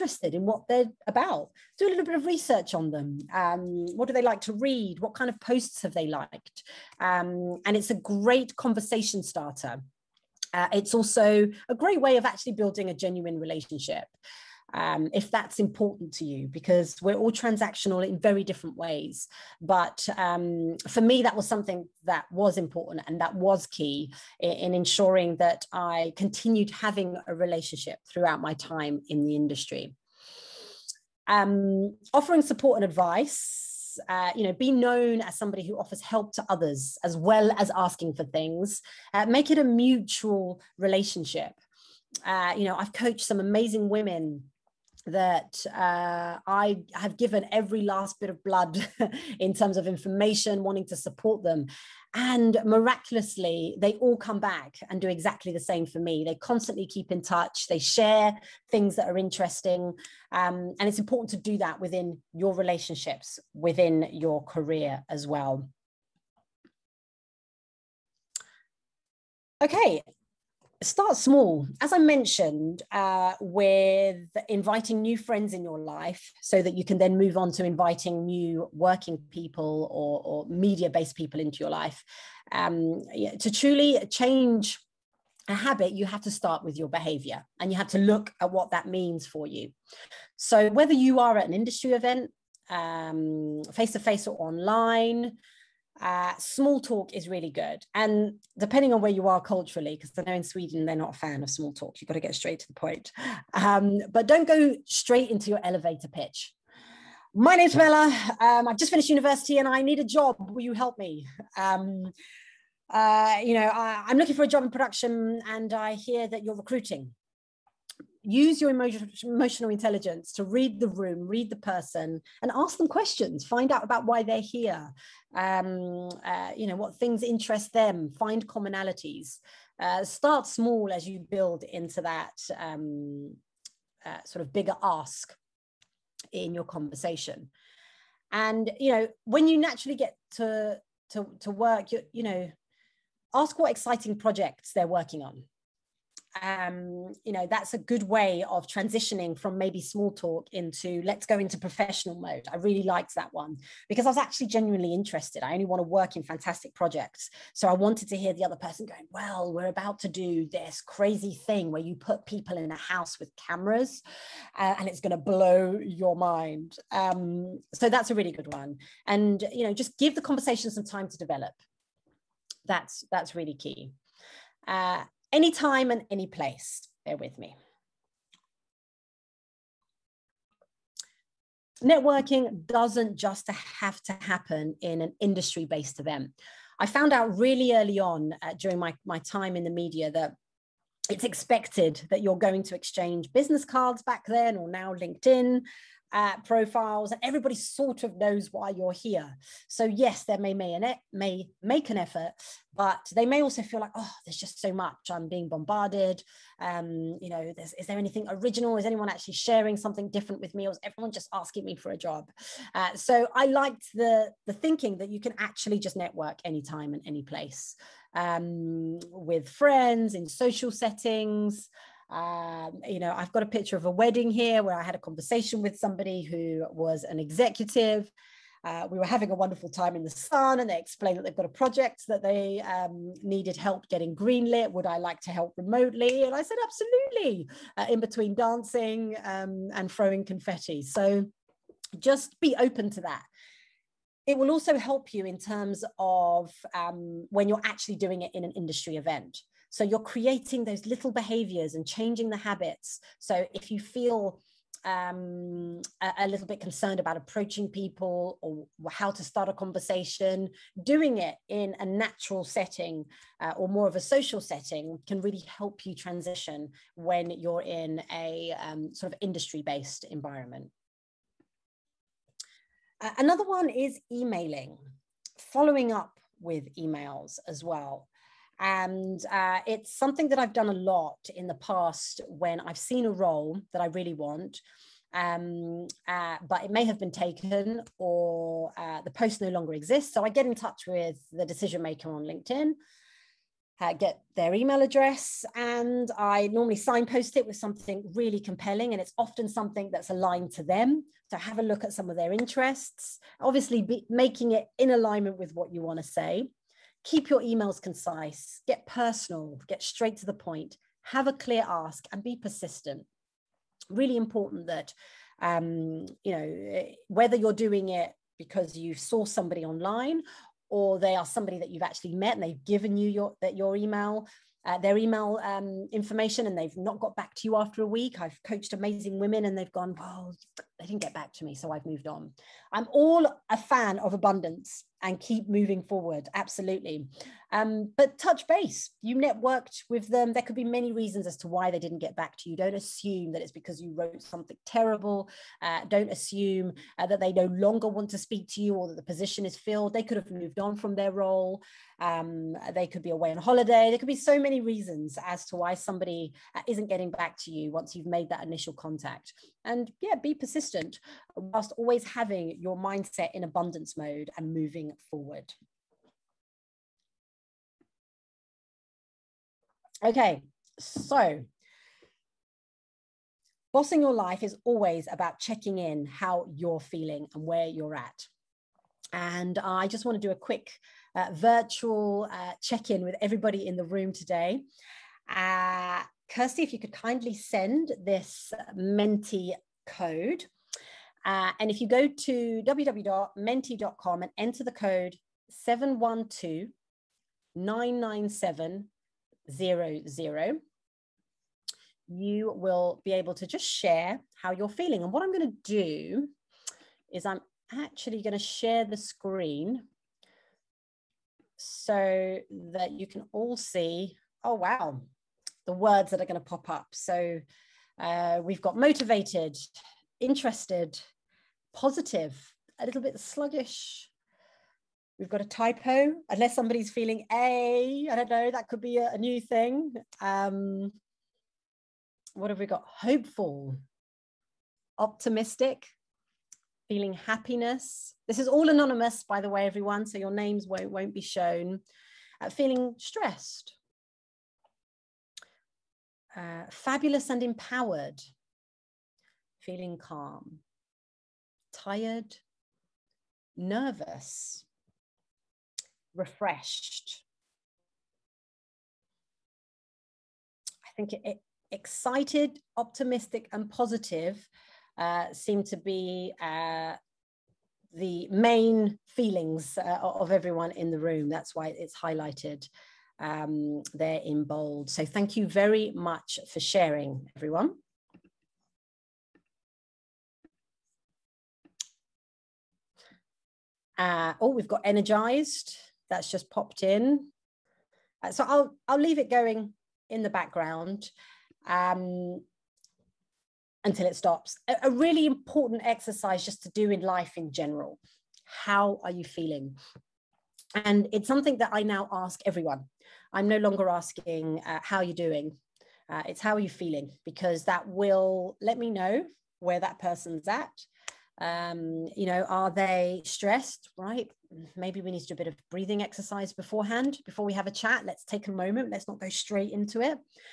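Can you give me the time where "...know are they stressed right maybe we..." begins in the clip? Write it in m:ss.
8:32.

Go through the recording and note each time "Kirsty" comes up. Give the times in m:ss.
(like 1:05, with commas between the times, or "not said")
6:26.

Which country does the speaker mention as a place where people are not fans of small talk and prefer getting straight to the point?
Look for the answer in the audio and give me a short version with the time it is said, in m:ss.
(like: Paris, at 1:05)
Sweden, at 1:40.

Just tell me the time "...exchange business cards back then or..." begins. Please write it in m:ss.
3:12.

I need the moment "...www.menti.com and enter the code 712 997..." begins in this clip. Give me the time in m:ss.
6:32.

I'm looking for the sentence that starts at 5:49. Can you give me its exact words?
They could have moved on from their role.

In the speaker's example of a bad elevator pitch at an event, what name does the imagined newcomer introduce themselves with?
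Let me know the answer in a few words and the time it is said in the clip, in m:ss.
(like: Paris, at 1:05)
Bella, at 1:47.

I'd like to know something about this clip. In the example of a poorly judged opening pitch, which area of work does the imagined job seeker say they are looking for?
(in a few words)
production.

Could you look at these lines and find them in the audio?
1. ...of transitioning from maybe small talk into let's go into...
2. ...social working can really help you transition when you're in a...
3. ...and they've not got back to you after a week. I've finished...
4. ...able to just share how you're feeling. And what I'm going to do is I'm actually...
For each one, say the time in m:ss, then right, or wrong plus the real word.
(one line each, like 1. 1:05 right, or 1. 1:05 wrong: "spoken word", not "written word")
1. 2:28 right
2. 4:23 wrong: "setting", not "working"
3. 5:26 wrong: "coached", not "finished"
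4. 6:43 right.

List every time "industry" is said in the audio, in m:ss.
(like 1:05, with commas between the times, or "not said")
0:29, 1:31, 3:05, 4:08, 4:29.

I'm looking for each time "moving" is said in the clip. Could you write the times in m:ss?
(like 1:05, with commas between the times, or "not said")
5:35, 6:04.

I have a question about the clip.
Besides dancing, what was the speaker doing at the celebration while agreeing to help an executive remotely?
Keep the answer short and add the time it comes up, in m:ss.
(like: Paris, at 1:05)
throwing confetti, at 3:59.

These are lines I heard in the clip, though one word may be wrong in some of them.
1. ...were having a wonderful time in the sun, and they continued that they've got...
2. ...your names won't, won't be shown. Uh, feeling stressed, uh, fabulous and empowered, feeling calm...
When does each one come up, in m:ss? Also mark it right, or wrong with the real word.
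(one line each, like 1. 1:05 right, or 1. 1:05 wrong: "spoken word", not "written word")
1. 3:48 wrong: "explained", not "continued"
2. 7:20 right.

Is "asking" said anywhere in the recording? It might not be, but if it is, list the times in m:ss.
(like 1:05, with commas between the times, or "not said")
0:37, 3:31, 8:23.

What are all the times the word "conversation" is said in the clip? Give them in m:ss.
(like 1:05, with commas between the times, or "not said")
0:08, 2:16, 2:50, 3:44, 4:19.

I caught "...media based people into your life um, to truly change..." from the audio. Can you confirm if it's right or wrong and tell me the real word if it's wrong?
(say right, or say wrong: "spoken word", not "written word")
right.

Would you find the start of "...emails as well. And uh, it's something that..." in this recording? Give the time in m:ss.
4:36.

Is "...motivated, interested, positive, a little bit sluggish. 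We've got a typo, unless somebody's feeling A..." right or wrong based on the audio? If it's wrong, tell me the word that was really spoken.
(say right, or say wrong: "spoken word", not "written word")
right.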